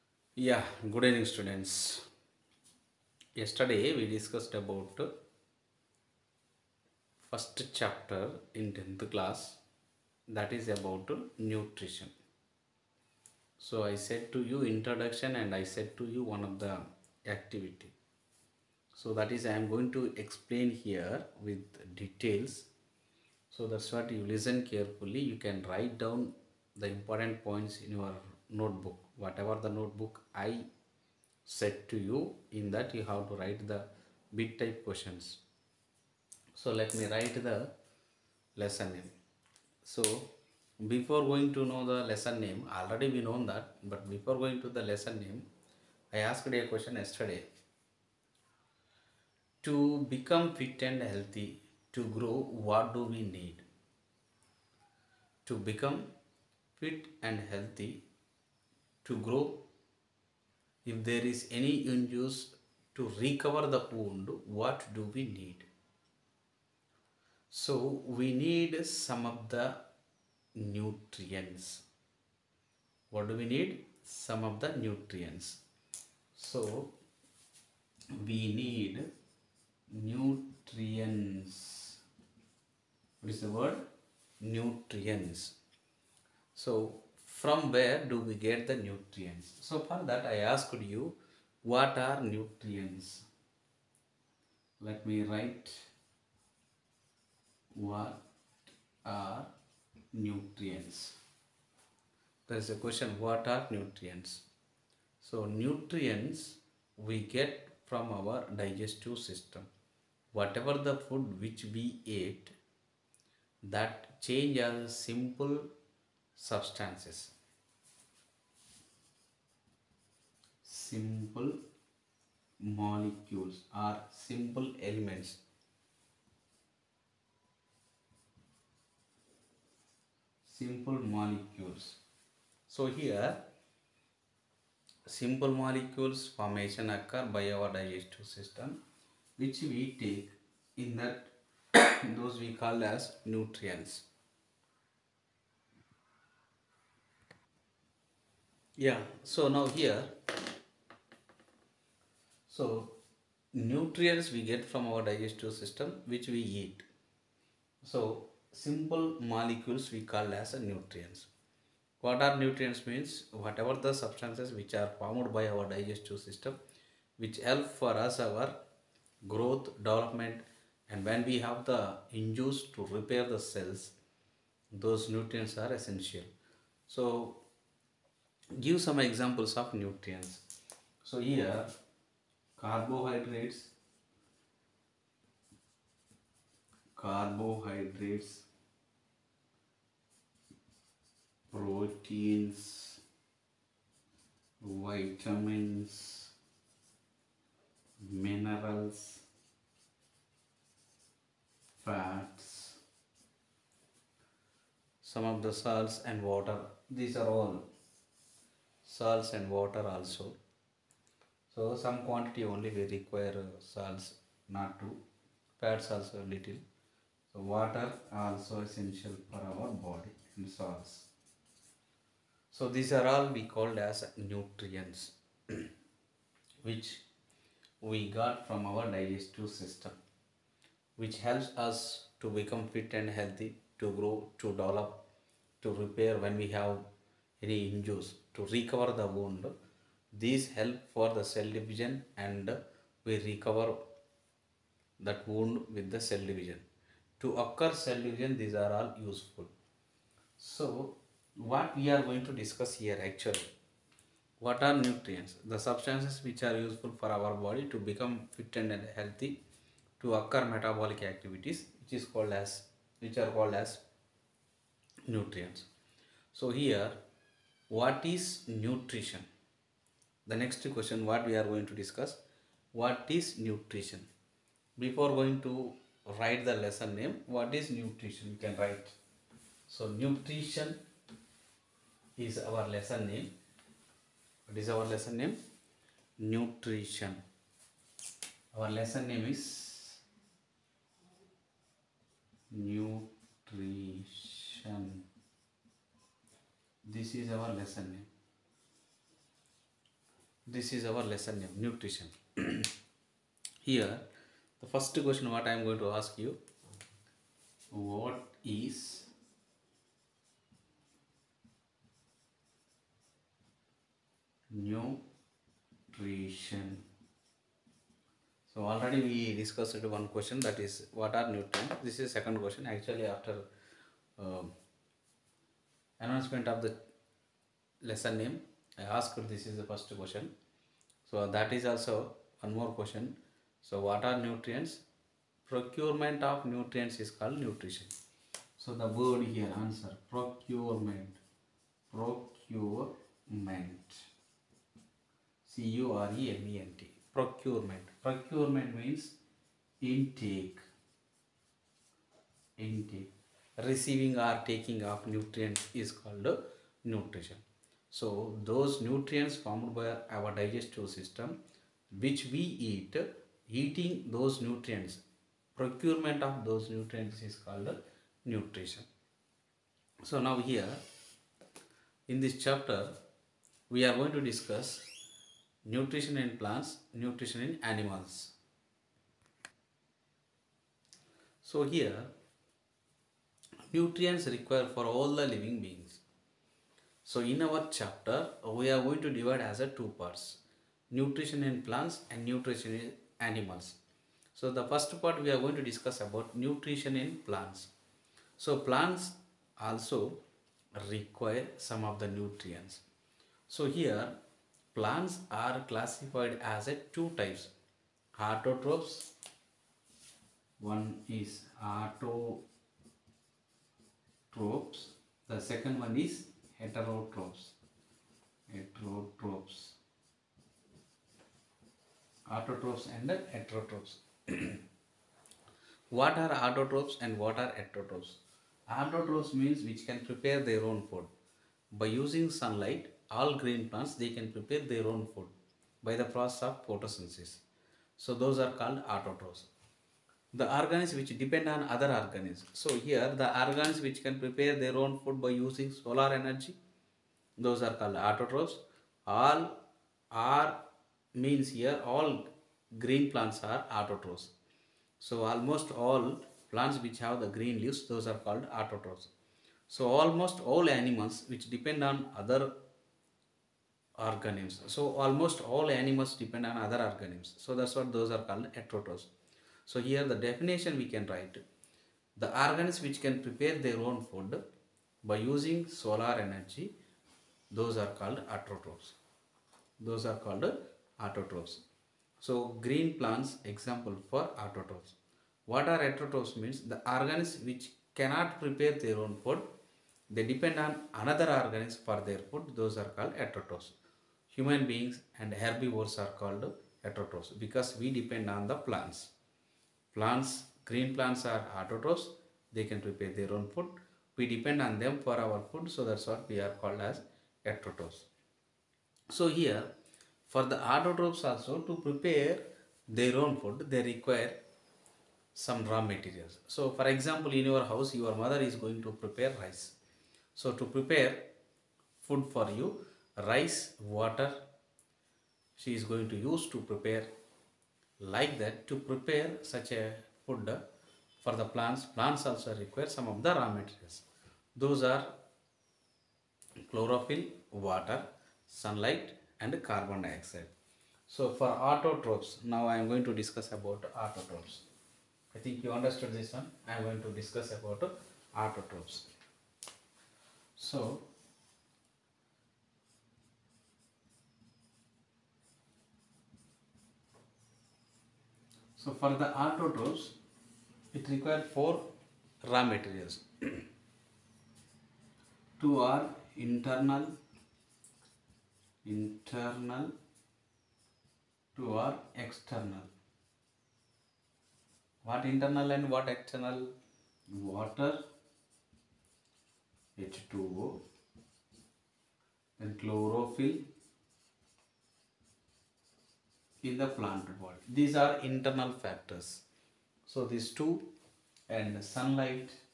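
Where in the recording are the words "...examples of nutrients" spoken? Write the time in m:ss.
2:58.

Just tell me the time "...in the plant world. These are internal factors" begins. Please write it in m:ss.
9:46.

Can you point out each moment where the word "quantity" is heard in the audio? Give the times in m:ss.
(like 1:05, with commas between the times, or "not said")
3:32.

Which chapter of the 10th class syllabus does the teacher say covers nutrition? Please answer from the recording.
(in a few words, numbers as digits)
First chapter.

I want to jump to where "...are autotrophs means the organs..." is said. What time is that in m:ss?
8:05.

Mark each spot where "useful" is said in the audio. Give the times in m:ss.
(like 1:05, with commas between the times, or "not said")
4:09, 4:16.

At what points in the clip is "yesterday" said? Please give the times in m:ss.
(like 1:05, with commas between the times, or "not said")
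0:03, 0:46.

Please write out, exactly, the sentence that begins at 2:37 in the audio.
So simple molecules we call as nutrients.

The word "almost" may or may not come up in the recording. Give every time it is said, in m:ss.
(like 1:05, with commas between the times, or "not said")
7:35, 7:39, 7:44.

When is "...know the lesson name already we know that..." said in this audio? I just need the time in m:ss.
0:41.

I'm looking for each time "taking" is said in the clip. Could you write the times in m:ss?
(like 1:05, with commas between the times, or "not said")
5:54.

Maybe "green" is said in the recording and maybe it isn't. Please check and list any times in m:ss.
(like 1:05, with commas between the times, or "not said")
7:13, 7:32, 7:37, 8:02, 8:20.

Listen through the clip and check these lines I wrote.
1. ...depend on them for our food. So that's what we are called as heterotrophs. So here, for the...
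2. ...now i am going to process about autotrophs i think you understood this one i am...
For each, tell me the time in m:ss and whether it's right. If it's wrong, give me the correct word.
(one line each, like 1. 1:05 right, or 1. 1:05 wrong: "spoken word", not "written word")
1. 8:24 right
2. 9:02 wrong: "discuss", not "process".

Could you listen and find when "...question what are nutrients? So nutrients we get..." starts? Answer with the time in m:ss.
1:42.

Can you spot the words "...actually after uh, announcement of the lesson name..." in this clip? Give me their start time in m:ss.
5:22.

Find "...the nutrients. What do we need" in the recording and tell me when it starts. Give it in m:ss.
1:09.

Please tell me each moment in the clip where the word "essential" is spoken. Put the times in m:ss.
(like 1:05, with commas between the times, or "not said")
2:55, 3:38.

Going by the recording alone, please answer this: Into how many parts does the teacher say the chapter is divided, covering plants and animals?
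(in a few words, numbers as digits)
2.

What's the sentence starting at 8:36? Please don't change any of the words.
So for example, in your house, your mother is going to prepare rice.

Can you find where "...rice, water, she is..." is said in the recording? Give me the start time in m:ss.
8:43.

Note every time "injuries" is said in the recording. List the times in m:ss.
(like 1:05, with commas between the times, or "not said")
1:01, 3:57.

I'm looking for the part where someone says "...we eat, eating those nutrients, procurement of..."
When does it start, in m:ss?
6:02.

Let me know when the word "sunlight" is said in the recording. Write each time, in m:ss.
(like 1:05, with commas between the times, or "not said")
7:12, 8:58, 9:51.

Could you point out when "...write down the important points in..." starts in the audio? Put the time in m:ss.
0:25.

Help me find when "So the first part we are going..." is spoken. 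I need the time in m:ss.
6:34.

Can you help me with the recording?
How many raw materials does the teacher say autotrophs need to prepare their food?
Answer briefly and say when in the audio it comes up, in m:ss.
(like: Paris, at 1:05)
4, at 9:21.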